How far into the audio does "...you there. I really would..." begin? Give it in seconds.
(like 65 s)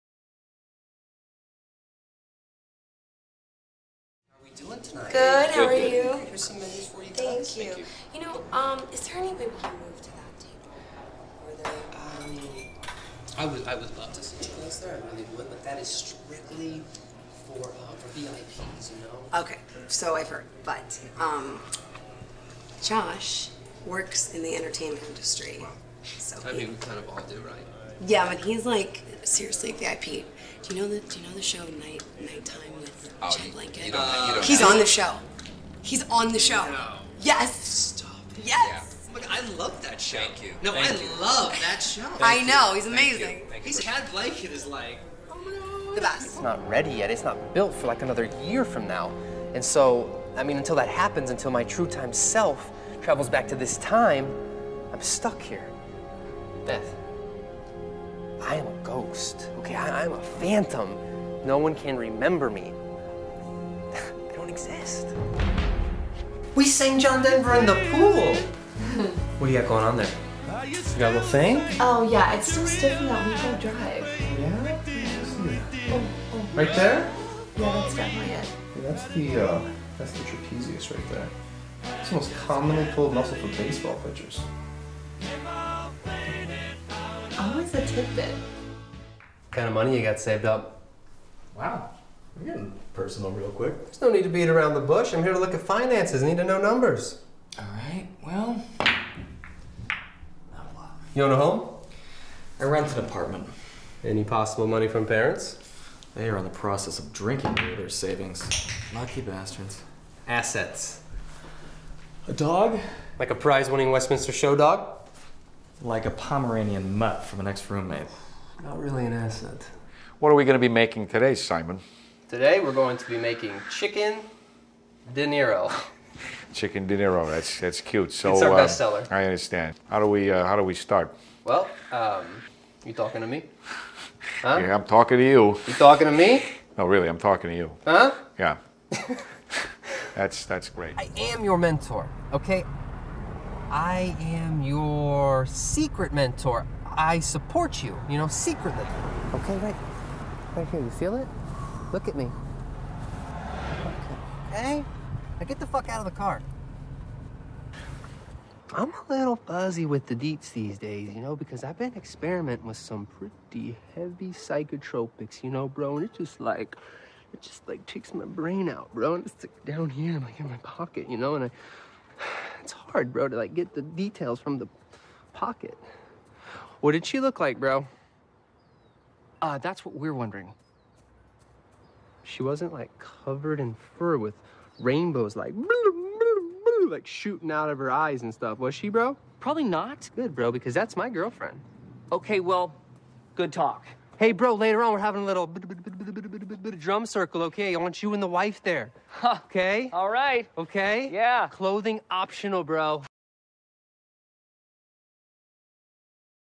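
14 s.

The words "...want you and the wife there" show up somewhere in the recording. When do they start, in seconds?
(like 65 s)
197 s.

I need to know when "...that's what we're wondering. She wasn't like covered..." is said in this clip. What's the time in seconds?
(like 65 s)
179 s.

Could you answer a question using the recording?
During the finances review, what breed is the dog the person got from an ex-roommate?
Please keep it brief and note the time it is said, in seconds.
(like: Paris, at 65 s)
Pomeranian mutt, at 116 s.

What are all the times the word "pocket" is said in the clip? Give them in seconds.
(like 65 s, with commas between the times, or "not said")
170 s, 175 s.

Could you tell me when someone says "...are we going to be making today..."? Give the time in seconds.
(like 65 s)
120 s.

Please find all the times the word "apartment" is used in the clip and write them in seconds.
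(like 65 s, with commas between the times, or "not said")
103 s.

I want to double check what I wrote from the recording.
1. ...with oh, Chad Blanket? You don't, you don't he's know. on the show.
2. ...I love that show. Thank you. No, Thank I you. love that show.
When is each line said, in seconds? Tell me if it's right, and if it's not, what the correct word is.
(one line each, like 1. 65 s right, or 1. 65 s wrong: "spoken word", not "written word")
1. 32 s right
2. 39 s right.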